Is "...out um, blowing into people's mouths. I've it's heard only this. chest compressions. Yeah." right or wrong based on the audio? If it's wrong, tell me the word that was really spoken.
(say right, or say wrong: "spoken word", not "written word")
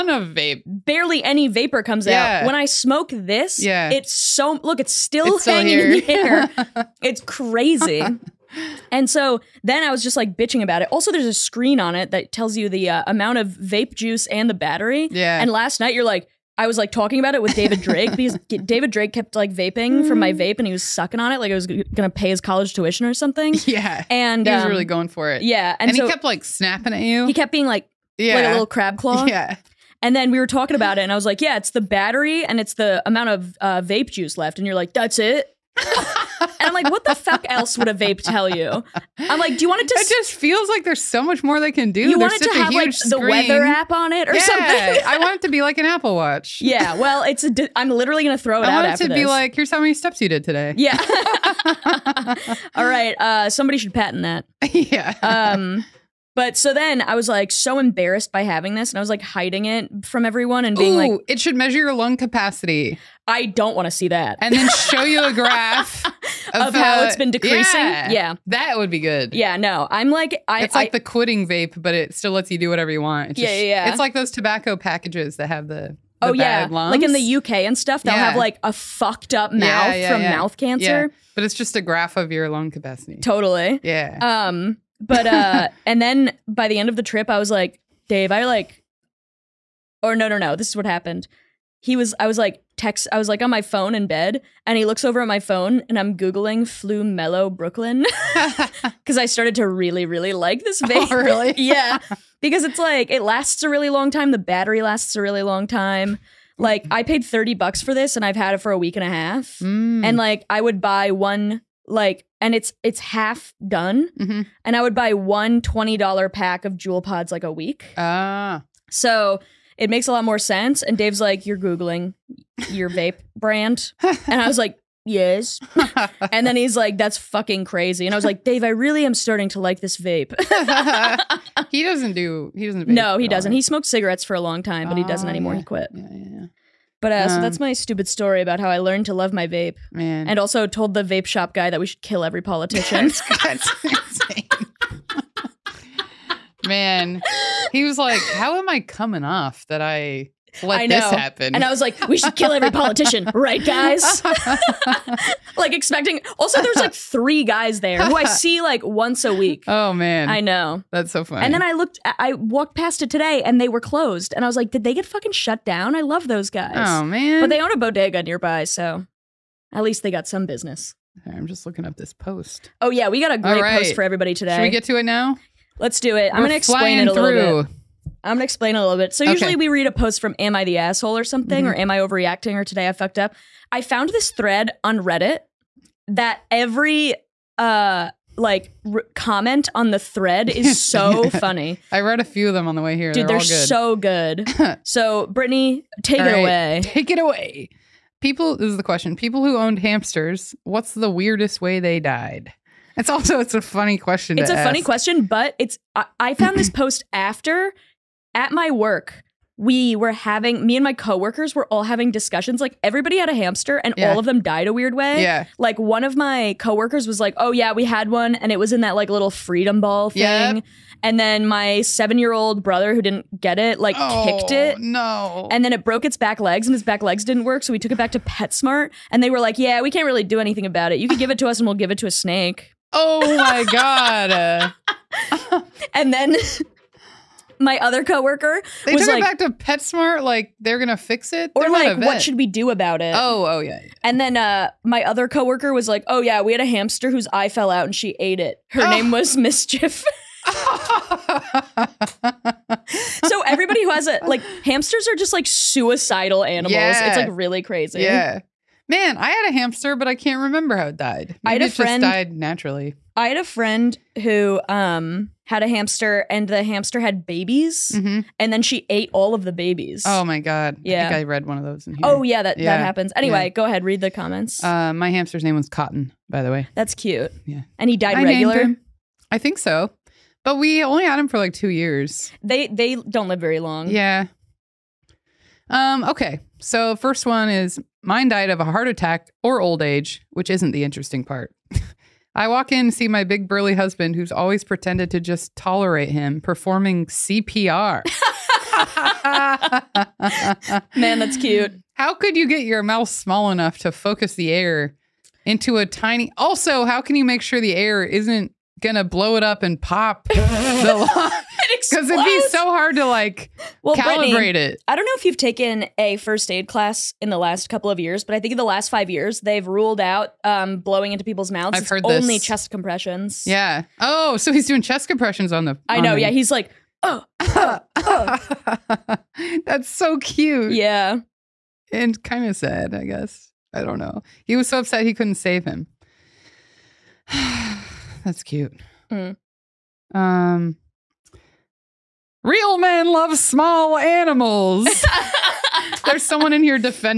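right.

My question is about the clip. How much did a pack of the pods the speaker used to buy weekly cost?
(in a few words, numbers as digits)
$20.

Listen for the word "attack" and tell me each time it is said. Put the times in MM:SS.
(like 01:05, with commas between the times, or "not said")
04:48.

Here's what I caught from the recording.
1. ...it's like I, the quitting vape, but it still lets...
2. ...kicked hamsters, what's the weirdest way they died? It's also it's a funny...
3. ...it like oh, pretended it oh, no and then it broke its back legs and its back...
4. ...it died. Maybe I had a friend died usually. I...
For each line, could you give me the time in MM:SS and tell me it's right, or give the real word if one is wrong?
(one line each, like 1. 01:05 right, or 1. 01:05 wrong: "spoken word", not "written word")
1. 01:10 right
2. 03:19 wrong: "owned", not "kicked"
3. 03:43 wrong: "kicked", not "pretended"
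4. 04:20 wrong: "naturally", not "usually".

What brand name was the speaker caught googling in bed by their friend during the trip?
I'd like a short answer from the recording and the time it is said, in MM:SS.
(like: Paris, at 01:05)
Flum Mello, at 01:36.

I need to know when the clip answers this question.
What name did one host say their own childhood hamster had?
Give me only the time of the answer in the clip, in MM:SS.
04:35.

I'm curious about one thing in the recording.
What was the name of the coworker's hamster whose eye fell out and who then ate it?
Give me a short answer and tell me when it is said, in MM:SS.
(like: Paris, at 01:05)
Mischief, at 04:09.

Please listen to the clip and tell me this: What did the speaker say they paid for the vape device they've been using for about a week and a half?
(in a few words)
$30.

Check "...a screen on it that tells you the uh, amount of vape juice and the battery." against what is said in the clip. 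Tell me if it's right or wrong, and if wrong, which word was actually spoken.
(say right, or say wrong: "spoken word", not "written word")
right.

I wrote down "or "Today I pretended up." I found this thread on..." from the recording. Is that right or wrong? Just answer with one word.
wrong.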